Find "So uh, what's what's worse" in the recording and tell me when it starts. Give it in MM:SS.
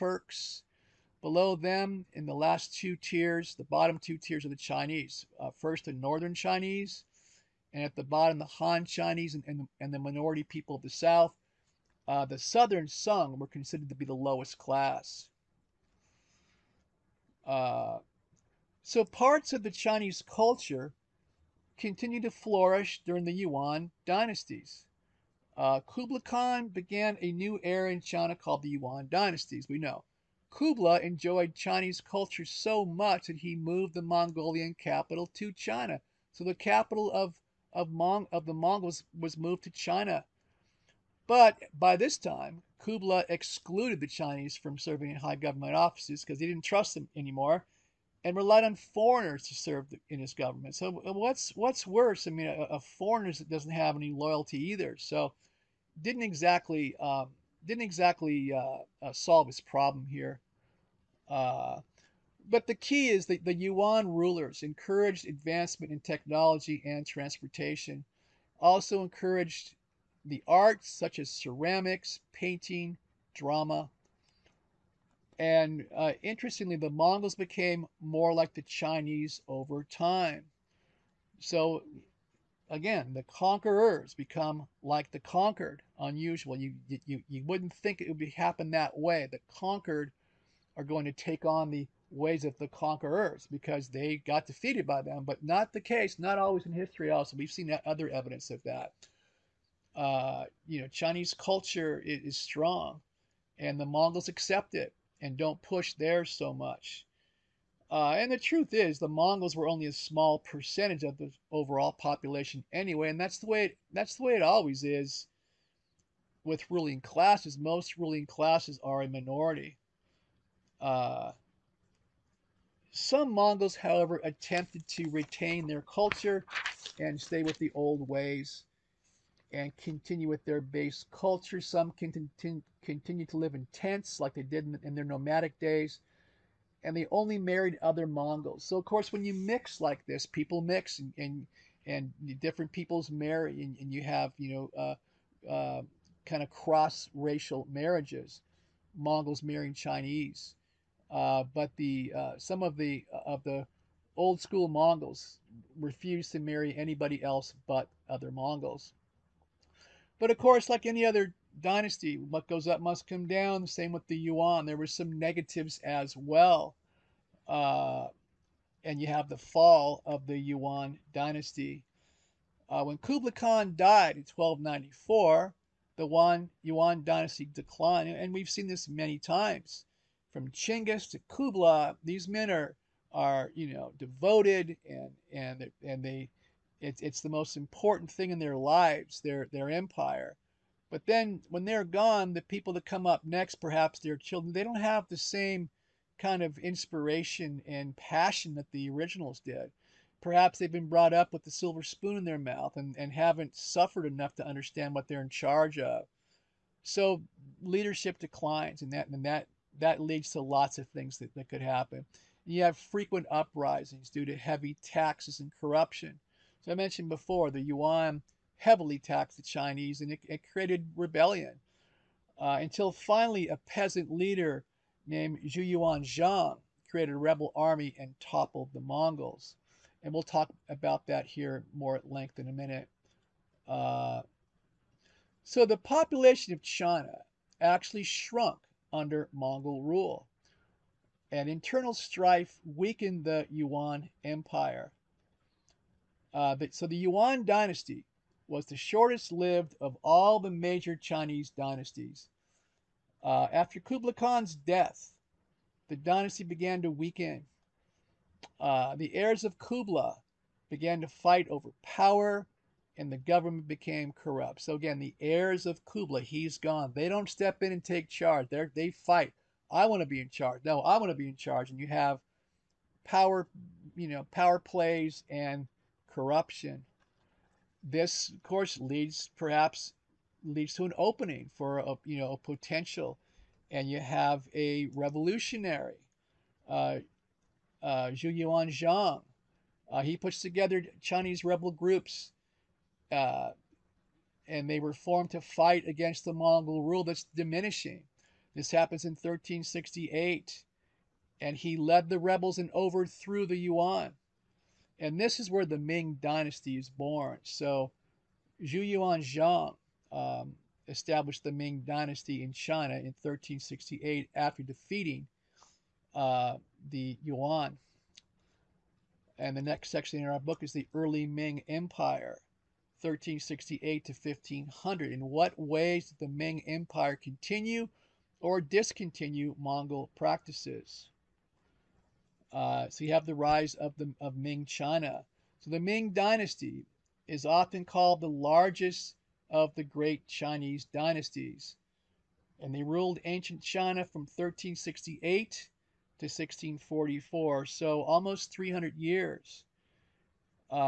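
00:50.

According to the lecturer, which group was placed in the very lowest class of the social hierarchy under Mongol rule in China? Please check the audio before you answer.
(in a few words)
Southern Sung.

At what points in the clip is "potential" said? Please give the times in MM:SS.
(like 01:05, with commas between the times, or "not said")
04:42.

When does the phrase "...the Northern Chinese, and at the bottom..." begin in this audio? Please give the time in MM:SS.
00:05.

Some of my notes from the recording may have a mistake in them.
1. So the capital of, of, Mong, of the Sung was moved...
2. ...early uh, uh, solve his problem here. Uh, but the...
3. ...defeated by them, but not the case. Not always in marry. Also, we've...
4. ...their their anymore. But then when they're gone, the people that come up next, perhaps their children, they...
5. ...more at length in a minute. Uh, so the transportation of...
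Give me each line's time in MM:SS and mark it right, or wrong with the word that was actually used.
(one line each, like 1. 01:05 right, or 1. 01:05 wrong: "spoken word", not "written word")
1. 00:36 wrong: "Mongols", not "Sung"
2. 00:57 wrong: "exactly", not "early"
3. 01:34 wrong: "history", not "marry"
4. 03:09 wrong: "empire", not "anymore"
5. 03:51 wrong: "population", not "transportation".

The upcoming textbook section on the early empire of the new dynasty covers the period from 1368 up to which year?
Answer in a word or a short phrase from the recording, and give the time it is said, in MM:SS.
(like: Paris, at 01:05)
1500, at 05:24.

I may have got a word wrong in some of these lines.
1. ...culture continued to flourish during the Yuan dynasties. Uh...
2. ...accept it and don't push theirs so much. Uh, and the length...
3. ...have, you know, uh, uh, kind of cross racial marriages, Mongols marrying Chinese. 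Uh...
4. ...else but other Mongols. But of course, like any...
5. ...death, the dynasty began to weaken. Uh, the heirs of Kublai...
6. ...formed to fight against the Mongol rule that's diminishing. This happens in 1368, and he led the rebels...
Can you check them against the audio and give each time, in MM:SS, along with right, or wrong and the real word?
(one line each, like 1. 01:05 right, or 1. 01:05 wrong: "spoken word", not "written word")
1. 00:20 right
2. 01:44 wrong: "truth", not "length"
3. 02:24 right
4. 02:37 right
5. 04:14 right
6. 04:54 right.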